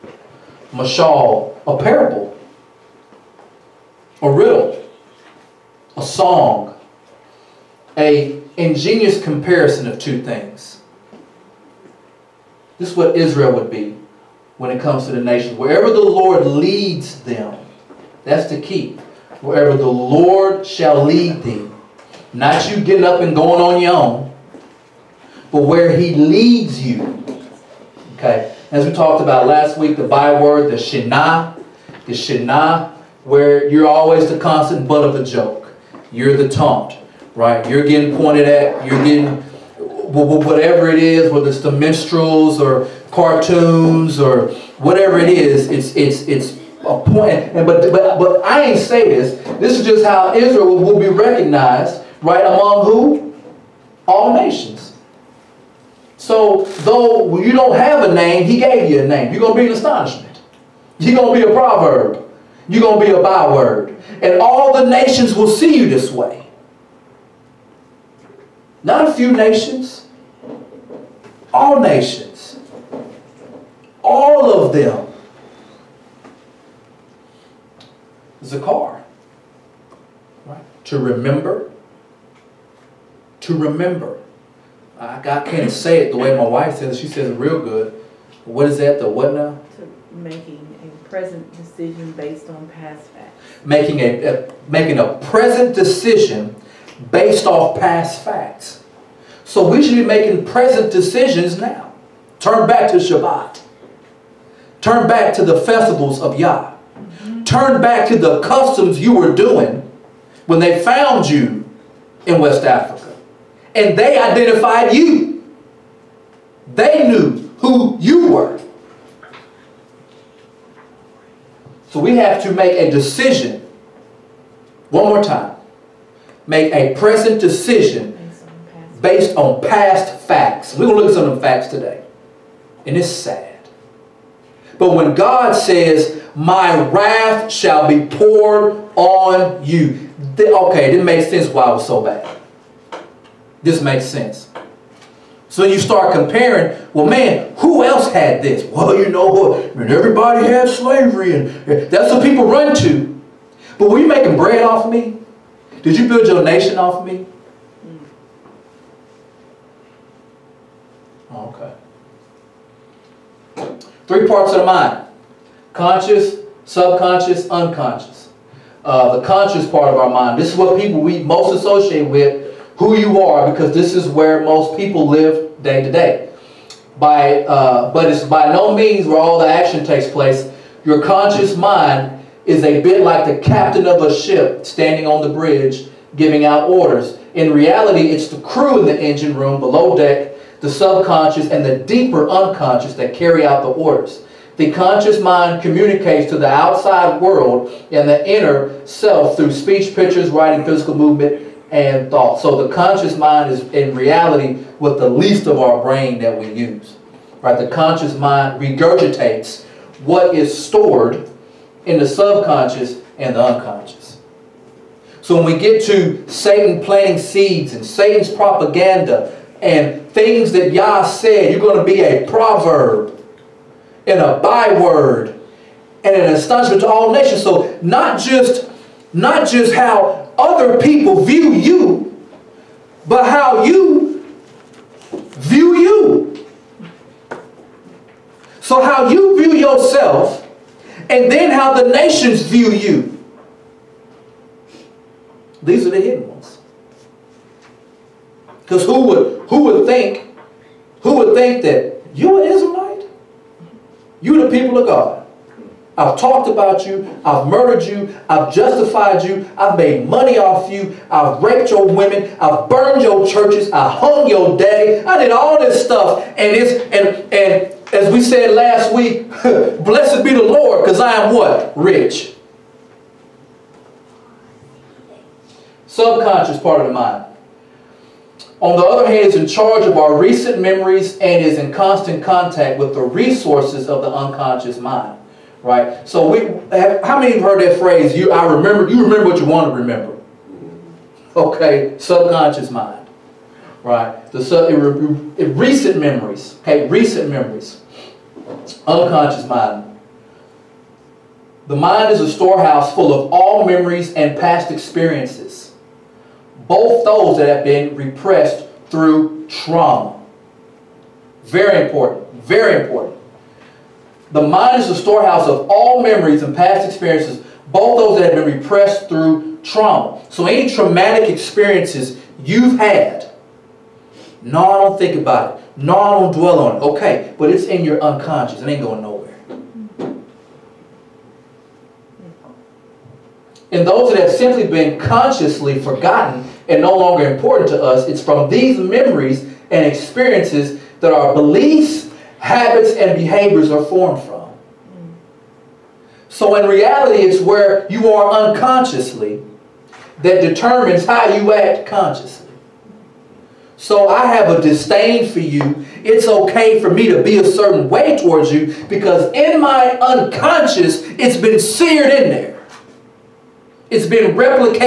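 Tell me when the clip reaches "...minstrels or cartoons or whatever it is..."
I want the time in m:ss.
0:41.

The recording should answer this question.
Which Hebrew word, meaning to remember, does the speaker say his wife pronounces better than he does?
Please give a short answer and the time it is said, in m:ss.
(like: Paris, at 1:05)
Zakar, at 1:18.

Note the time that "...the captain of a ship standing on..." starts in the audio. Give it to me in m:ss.
3:03.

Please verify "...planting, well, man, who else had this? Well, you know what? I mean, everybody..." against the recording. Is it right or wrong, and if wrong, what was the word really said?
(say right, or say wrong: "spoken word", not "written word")
wrong: "comparing", not "planting".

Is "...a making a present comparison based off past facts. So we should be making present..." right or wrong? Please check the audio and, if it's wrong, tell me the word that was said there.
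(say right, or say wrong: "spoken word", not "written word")
wrong: "decision", not "comparison".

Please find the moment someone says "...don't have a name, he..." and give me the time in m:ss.
0:57.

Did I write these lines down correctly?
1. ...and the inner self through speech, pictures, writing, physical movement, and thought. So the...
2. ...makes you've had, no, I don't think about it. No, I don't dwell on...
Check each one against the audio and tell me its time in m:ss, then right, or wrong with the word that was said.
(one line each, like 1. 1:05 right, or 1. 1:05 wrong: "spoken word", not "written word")
1. 3:17 right
2. 5:21 wrong: "experiences", not "makes".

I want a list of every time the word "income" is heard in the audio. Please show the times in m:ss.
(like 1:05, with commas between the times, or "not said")
not said.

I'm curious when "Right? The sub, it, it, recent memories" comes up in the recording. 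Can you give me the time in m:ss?
4:53.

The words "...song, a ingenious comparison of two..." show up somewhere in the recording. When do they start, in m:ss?
0:06.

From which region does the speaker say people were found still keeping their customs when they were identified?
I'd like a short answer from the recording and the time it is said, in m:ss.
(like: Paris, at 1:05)
West Africa, at 1:52.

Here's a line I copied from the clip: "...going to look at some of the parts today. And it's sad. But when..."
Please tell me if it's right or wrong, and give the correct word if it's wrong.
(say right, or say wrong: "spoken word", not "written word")
wrong: "facts", not "parts".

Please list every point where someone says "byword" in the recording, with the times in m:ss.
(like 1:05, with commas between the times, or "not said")
0:30, 1:03, 3:44.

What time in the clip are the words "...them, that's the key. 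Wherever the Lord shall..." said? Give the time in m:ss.
0:17.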